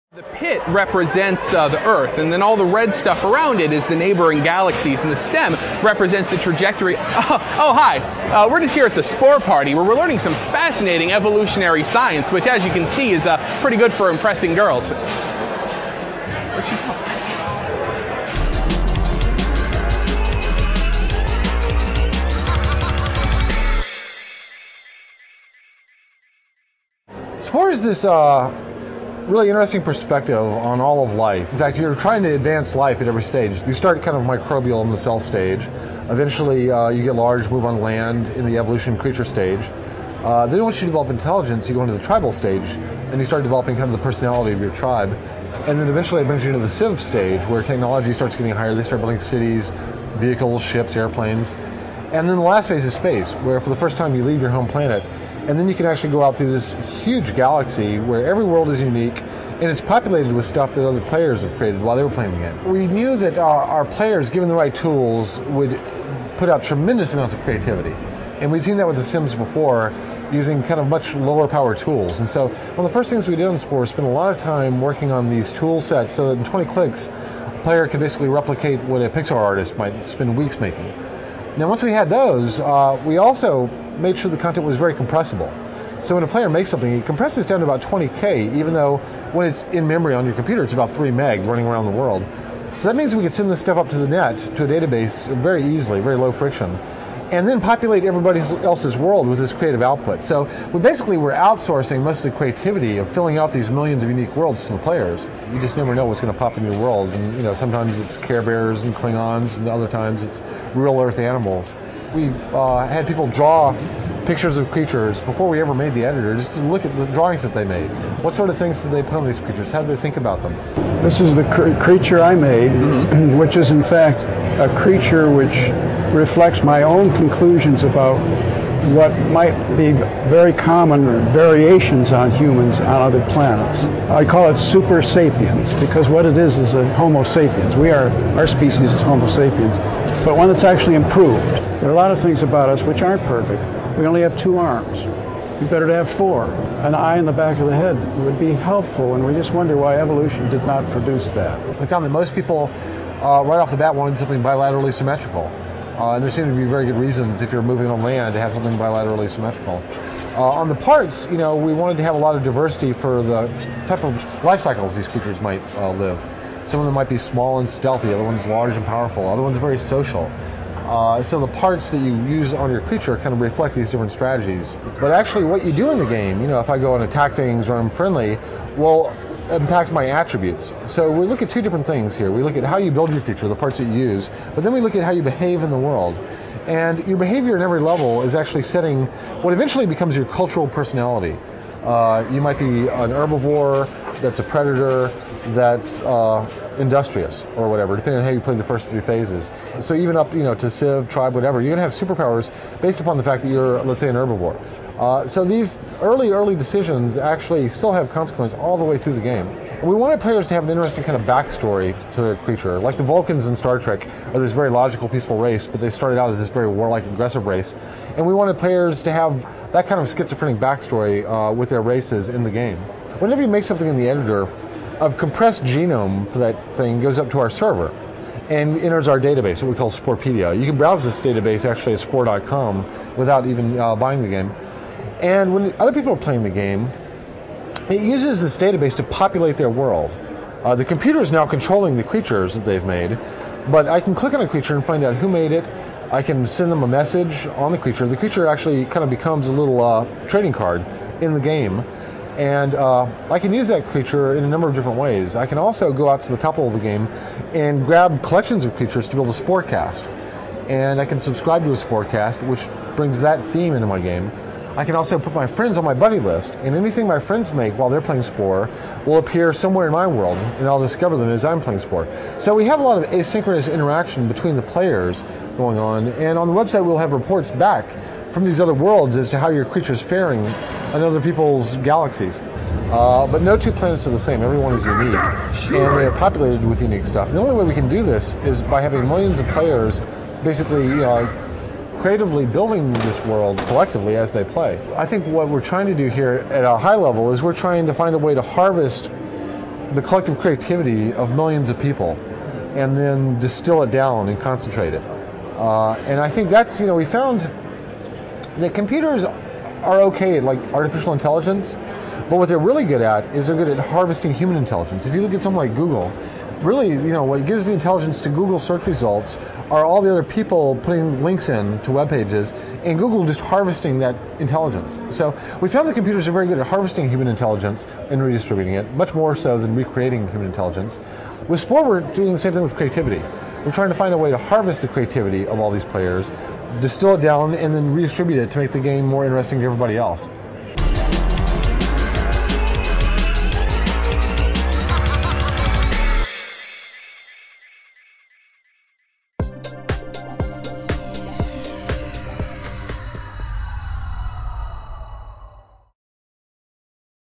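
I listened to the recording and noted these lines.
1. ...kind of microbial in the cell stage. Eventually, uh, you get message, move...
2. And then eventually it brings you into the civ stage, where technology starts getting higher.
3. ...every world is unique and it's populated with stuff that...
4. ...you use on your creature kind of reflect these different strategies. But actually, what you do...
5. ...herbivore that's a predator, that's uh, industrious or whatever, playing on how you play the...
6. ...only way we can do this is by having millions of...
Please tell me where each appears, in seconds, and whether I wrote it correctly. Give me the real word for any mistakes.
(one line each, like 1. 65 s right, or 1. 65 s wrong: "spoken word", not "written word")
1. 34 s wrong: "large", not "message"
2. 45 s right
3. 58 s right
4. 172 s right
5. 193 s wrong: "depending", not "playing"
6. 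287 s right.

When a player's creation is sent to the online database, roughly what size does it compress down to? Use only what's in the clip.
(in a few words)
20K.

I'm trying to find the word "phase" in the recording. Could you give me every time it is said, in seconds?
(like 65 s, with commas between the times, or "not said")
52 s, 199 s.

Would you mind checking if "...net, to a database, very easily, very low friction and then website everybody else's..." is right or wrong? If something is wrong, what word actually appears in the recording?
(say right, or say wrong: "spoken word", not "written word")
wrong: "populate", not "website".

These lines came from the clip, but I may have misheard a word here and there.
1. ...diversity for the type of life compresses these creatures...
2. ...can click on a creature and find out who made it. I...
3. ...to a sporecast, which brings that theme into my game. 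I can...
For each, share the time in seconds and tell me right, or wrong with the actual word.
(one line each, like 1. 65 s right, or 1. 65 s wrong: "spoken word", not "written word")
1. 162 s wrong: "cycles", not "compresses"
2. 243 s right
3. 261 s right.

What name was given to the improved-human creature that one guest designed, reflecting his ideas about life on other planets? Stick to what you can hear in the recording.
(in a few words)
Super sapiens.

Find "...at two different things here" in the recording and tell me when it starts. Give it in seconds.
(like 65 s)
181 s.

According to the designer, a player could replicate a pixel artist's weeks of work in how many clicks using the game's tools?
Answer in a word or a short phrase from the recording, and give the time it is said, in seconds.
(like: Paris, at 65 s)
20, at 76 s.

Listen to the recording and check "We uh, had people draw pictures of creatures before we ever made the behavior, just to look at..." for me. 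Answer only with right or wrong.
wrong.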